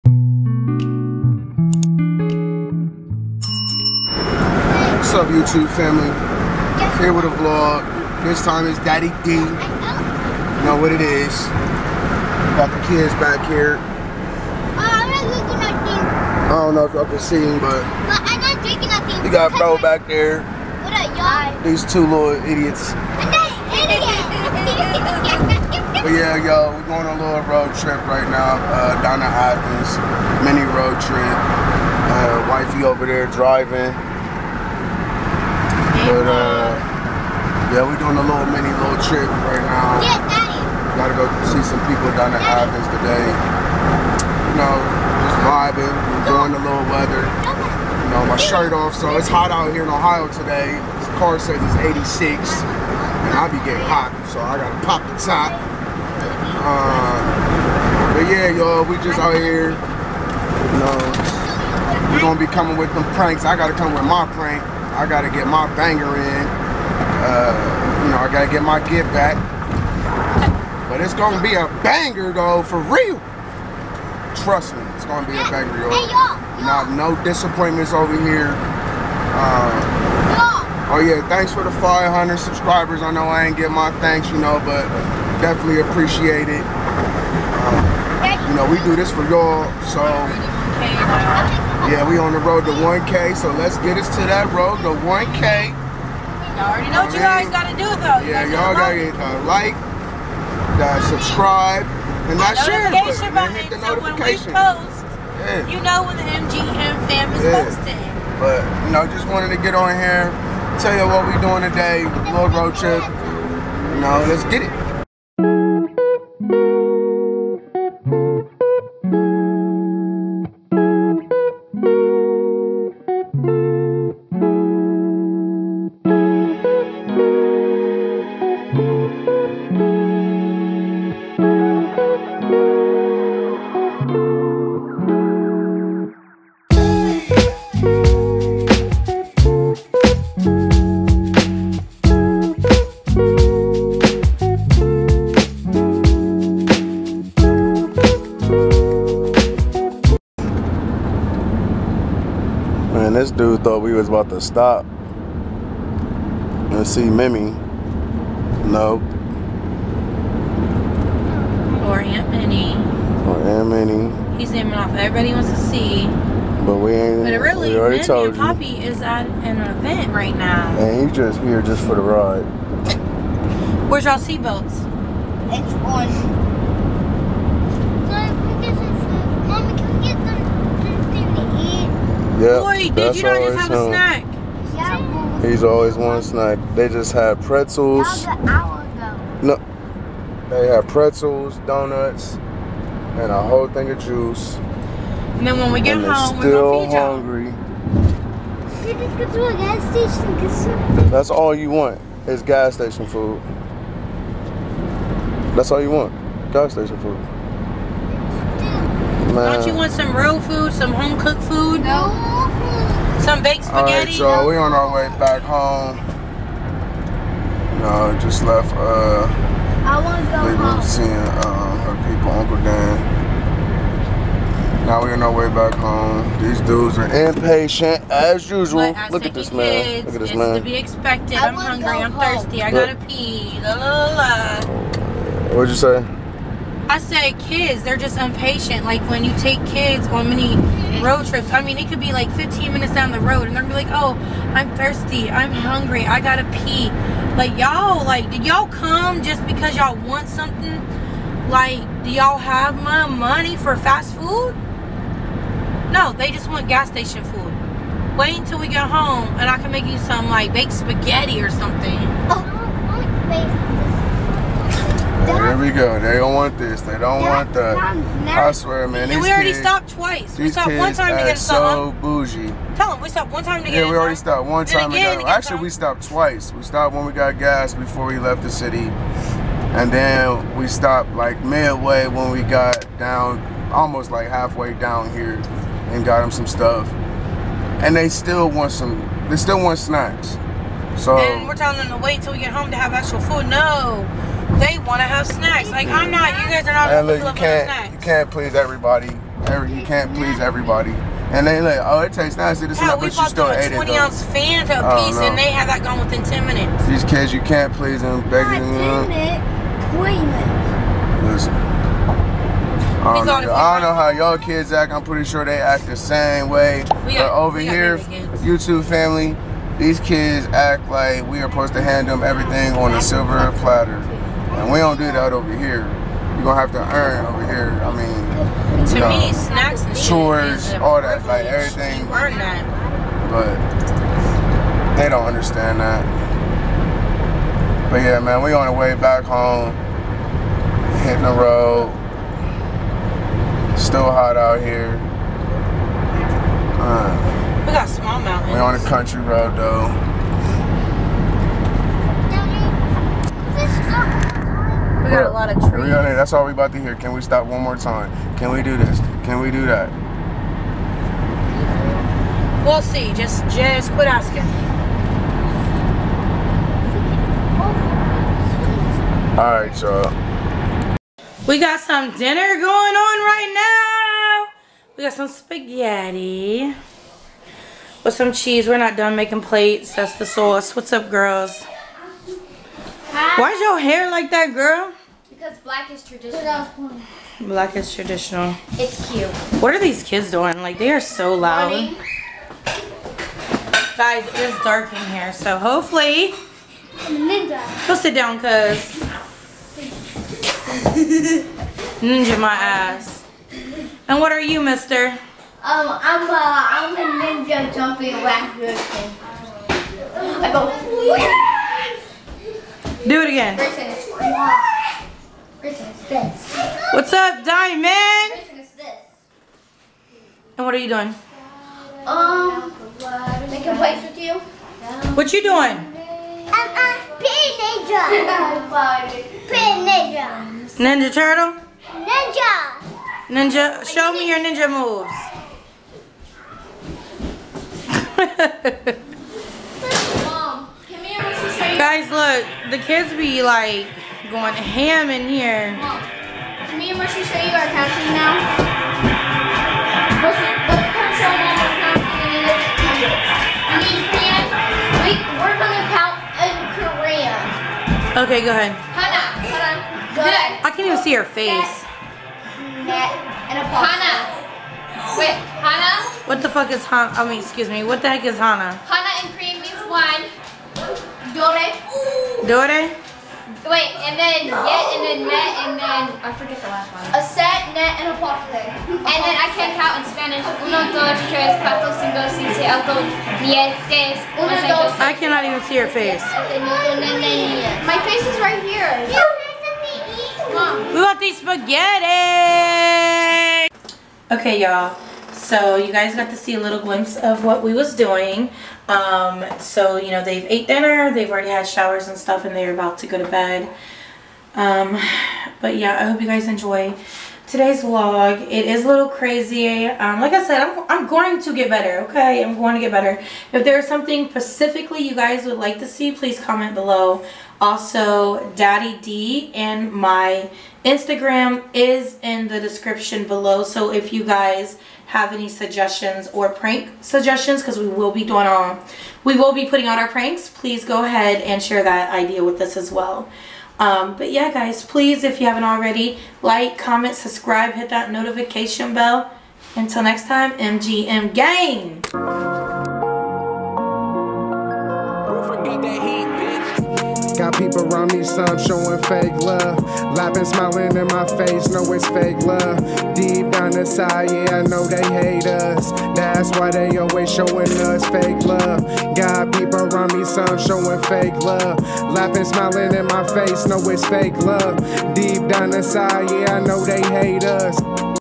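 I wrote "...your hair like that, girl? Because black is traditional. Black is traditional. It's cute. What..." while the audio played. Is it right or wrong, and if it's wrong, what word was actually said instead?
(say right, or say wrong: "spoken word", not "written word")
right.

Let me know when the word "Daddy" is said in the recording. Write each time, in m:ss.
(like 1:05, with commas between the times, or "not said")
0:08, 0:40, 8:38.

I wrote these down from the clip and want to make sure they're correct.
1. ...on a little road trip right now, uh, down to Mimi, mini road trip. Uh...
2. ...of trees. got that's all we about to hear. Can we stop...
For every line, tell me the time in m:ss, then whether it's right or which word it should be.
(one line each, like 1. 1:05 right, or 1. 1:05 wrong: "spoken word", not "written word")
1. 0:27 wrong: "Athens", not "Mimi"
2. 5:55 right.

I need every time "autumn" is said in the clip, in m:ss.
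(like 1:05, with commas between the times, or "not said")
not said.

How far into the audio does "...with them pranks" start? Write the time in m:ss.
1:02.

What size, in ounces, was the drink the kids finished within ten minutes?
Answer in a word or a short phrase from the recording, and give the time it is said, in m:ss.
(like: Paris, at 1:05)
20, at 5:03.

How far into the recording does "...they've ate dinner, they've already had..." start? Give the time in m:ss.
8:20.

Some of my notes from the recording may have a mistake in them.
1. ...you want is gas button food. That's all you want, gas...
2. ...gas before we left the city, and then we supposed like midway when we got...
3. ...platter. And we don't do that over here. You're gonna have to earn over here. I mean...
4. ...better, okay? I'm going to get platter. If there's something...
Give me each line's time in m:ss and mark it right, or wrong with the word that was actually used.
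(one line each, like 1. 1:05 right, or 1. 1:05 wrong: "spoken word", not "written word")
1. 3:21 wrong: "station", not "button"
2. 4:37 wrong: "stopped", not "supposed"
3. 5:23 right
4. 8:31 wrong: "better", not "platter".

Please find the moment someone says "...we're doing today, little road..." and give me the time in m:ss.
1:51.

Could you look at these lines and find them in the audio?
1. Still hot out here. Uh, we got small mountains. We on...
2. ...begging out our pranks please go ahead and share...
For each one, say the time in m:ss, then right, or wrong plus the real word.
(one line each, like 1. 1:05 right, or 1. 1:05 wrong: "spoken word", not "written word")
1. 5:43 right
2. 8:49 wrong: "putting", not "begging".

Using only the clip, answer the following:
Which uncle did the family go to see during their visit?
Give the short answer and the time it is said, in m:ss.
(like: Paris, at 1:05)
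Uncle Dan, at 3:42.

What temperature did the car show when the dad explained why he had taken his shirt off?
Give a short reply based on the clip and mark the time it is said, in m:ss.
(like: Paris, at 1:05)
86, at 0:52.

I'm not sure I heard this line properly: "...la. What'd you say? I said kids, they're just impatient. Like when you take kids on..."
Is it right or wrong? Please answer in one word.
right.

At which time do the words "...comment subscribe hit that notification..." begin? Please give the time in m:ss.
8:56.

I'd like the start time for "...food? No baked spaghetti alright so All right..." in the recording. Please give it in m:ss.
3:31.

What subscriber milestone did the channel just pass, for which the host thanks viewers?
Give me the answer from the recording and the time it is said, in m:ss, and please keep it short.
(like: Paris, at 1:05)
500, at 1:21.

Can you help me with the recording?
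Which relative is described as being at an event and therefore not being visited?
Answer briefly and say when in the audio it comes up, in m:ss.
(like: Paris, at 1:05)
Poppy, at 2:48.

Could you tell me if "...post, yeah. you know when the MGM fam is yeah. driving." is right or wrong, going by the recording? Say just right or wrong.
wrong.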